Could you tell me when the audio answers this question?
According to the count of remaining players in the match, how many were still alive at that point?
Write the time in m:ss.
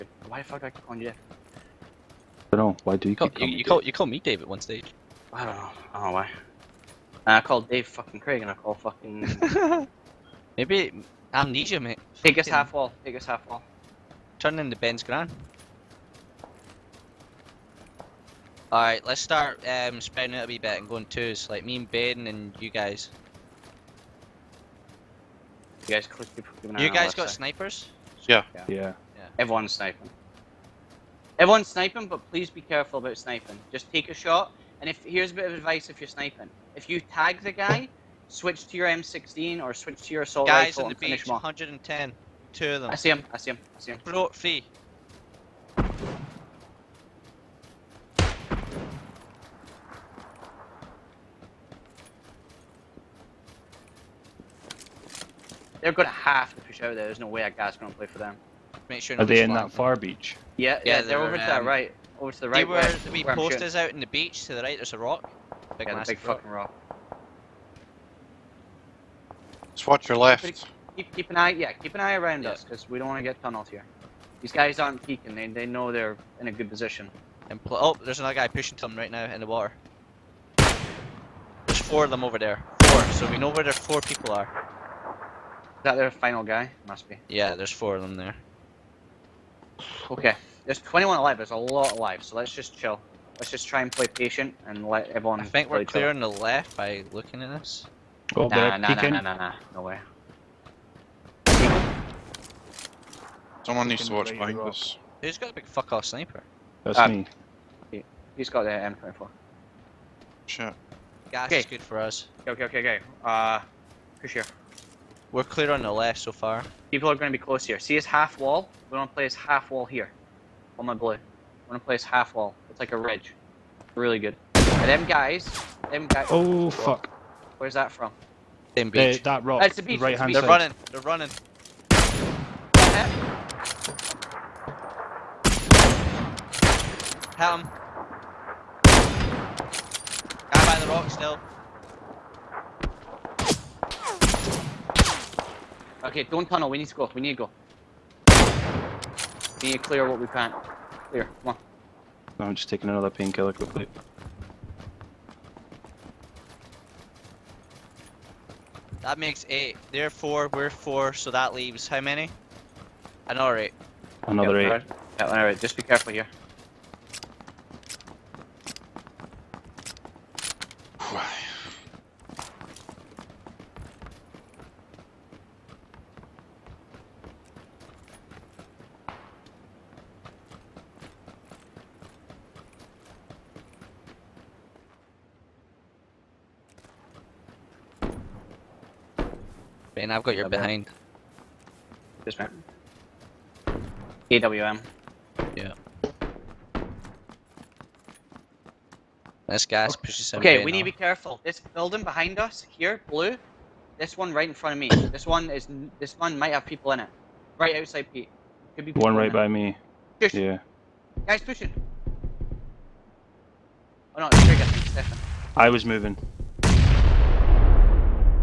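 1:30.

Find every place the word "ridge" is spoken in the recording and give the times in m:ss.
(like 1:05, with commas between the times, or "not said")
2:02.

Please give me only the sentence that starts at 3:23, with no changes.
This one right in front of me.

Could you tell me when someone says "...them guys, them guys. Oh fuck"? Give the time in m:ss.
2:04.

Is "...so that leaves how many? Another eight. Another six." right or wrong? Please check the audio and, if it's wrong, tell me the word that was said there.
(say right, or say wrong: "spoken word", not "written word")
wrong: "eight", not "six".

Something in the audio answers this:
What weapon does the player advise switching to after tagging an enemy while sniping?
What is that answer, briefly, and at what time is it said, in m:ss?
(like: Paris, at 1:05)
M16, at 0:38.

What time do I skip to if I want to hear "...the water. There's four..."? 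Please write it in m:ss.
1:19.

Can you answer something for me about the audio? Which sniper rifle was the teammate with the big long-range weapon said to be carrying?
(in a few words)
M24.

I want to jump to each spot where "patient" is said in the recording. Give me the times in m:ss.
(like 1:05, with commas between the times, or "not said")
1:34.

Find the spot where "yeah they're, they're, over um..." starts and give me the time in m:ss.
1:00.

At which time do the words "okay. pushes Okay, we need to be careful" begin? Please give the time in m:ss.
3:19.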